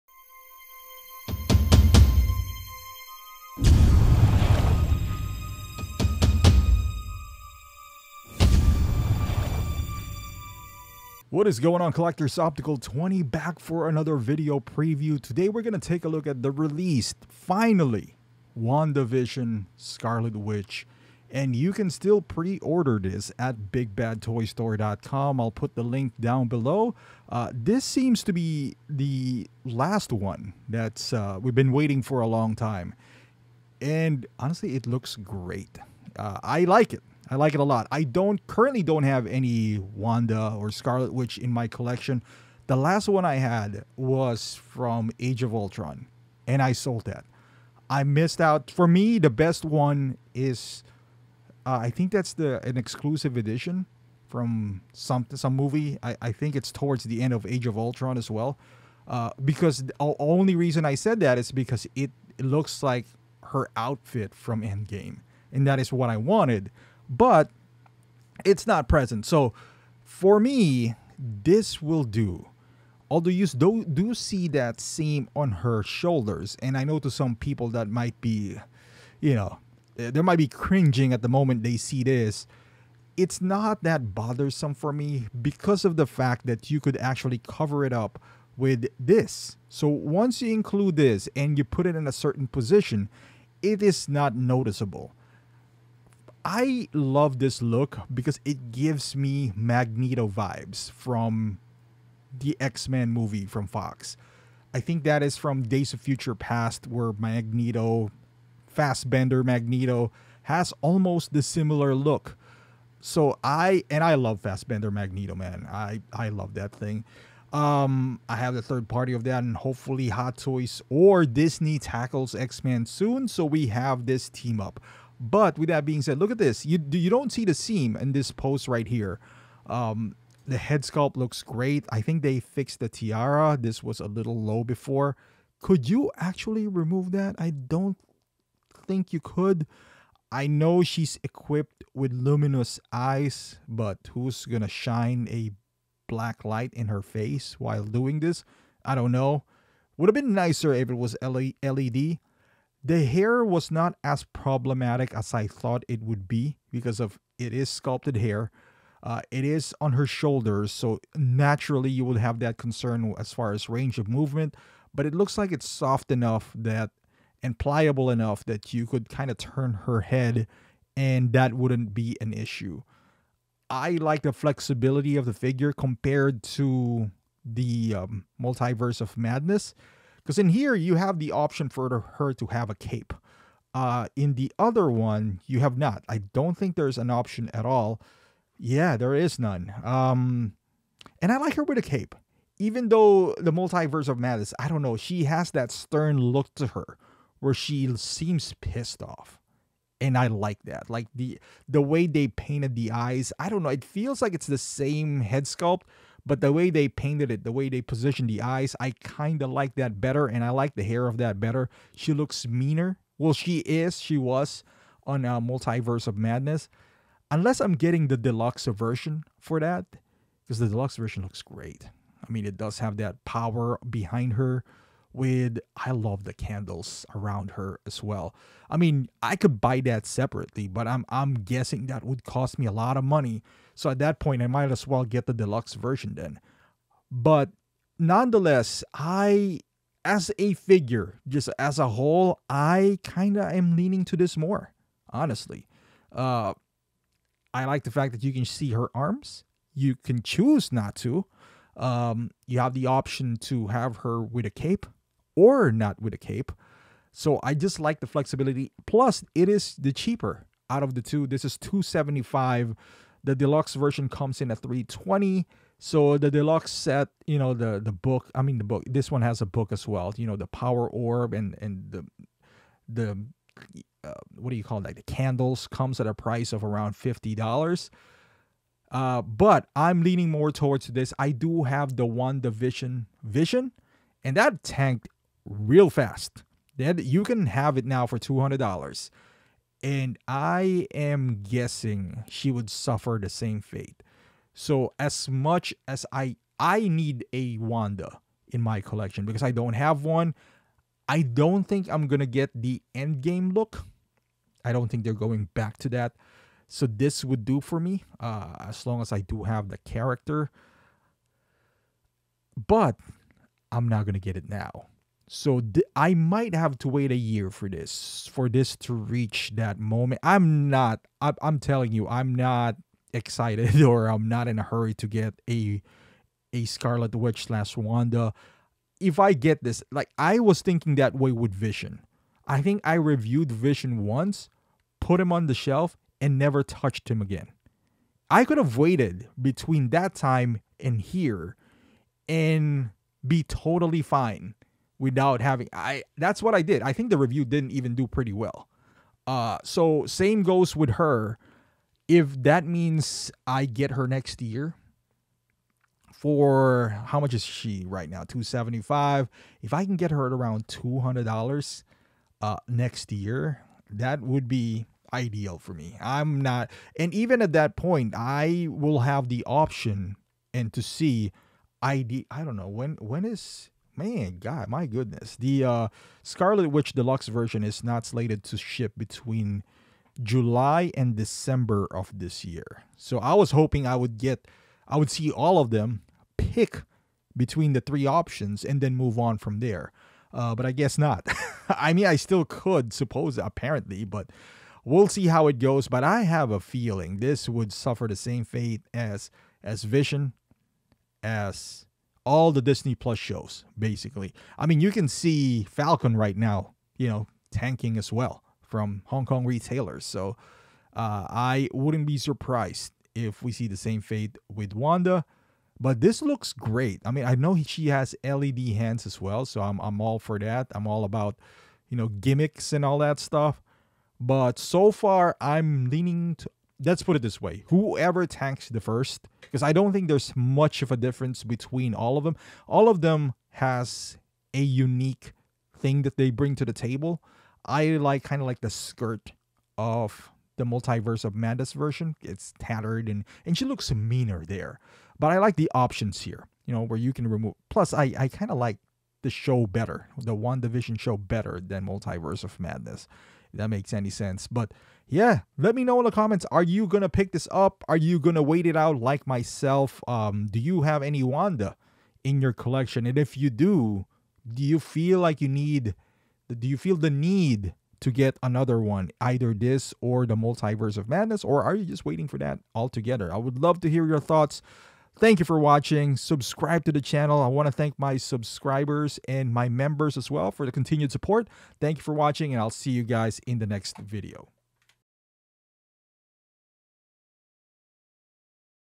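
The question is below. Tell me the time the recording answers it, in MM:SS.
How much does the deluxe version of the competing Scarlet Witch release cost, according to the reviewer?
04:24.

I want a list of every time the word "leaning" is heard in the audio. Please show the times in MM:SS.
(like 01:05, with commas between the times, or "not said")
04:03, 04:40, 07:05.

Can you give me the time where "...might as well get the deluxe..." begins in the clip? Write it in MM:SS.
03:54.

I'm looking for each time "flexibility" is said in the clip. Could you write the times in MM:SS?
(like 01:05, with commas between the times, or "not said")
02:54, 04:18.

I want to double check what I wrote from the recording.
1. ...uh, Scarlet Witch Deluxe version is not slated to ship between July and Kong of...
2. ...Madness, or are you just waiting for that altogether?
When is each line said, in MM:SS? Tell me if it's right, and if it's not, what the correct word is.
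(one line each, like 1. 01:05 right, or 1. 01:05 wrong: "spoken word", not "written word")
1. 06:15 wrong: "December", not "Kong"
2. 07:51 right.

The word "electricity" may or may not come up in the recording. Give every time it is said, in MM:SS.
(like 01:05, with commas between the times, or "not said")
not said.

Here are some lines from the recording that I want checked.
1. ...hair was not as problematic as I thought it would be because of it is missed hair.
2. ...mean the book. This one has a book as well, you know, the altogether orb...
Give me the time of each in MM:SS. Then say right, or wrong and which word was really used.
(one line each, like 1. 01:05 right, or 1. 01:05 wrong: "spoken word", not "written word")
1. 02:33 wrong: "sculpted", not "missed"
2. 04:28 wrong: "power", not "altogether".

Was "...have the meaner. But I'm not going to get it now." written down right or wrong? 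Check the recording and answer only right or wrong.
wrong.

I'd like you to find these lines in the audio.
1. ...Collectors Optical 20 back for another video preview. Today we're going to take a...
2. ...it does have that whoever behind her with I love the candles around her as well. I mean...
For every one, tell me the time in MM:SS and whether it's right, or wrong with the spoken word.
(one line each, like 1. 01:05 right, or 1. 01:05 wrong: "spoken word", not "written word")
1. 00:11 right
2. 03:42 wrong: "power", not "whoever".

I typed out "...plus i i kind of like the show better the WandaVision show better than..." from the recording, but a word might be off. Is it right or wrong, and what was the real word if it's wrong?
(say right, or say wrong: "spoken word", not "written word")
right.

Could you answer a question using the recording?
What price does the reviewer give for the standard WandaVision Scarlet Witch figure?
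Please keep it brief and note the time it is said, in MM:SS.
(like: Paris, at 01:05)
275, at 04:21.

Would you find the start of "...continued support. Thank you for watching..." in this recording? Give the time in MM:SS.
08:00.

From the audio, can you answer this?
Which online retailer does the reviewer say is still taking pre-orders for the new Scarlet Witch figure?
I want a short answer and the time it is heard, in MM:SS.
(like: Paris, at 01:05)
BigBadToyStore.com, at 00:23.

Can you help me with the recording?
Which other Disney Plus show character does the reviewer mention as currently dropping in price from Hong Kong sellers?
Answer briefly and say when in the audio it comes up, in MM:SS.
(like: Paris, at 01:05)
Falcon, at 06:45.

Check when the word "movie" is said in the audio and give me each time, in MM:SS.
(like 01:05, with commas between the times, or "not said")
00:55, 01:43.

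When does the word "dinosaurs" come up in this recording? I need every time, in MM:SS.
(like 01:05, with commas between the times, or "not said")
not said.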